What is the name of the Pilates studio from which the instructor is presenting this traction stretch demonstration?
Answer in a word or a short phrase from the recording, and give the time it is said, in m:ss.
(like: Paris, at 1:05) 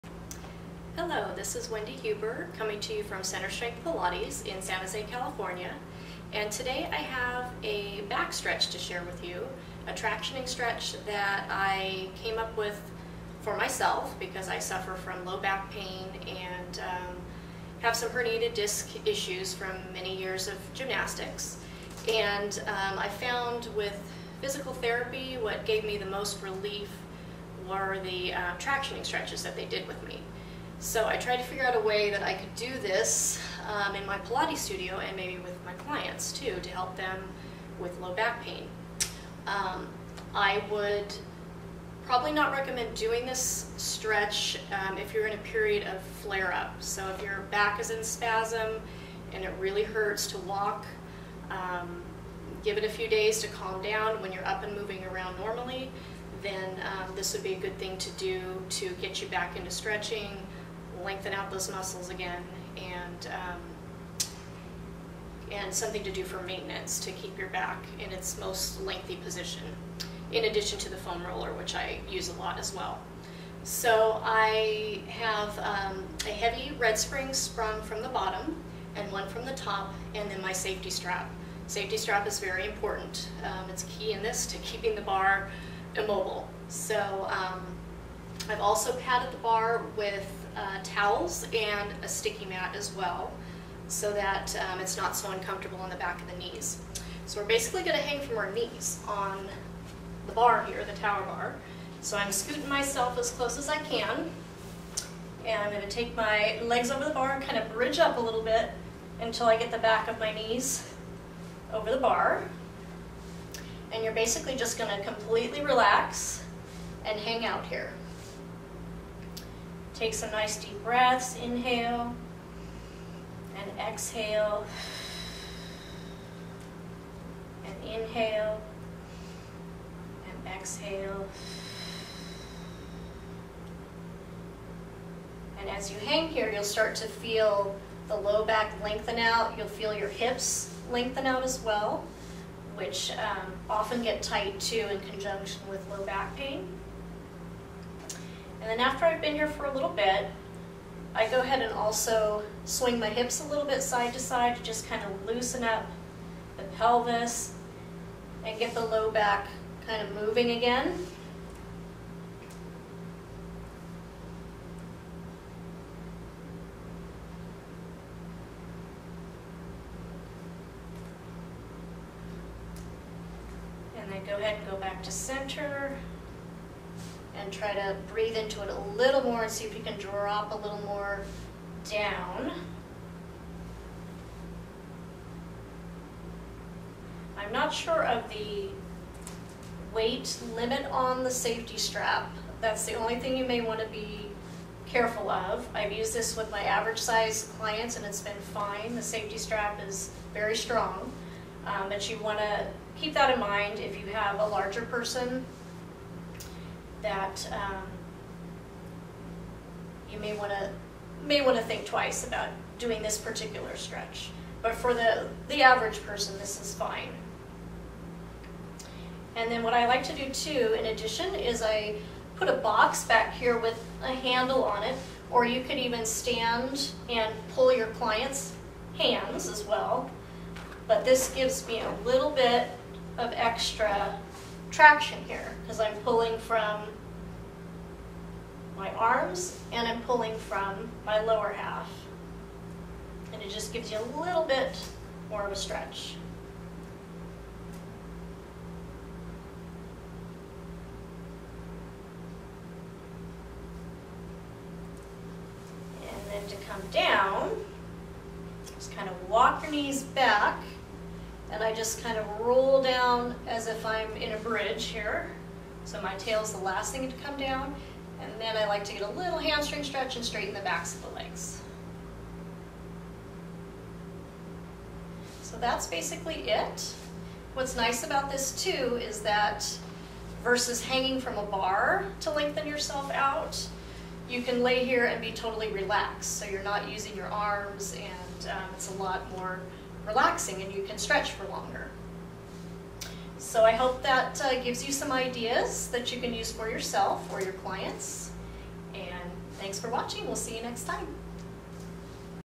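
Center Strength Pilates, at 0:03.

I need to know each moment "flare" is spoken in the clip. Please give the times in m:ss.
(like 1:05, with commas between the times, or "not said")
0:46.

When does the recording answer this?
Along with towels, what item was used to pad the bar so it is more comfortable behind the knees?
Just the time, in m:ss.
1:32.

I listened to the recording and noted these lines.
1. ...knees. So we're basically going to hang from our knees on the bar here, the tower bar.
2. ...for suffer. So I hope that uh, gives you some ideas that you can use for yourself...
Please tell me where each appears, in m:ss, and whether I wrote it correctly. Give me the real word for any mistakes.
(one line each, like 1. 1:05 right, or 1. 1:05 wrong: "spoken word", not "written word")
1. 1:36 right
2. 4:51 wrong: "longer", not "suffer".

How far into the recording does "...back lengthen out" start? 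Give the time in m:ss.
2:18.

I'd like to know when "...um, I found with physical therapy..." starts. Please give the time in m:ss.
0:22.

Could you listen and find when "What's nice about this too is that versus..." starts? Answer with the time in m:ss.
4:37.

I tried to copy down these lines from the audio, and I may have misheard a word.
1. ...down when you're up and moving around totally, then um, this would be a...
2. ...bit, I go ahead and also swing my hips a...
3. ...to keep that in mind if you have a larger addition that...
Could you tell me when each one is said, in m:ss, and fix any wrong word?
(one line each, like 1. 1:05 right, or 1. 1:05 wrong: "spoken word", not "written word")
1. 0:53 wrong: "normally", not "totally"
2. 2:29 right
3. 3:22 wrong: "person", not "addition".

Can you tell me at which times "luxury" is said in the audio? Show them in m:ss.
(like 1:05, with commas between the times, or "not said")
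not said.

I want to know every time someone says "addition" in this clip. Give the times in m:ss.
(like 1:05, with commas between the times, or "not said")
1:10, 3:40.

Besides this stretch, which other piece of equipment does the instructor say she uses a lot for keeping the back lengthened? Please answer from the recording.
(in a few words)
foam roller.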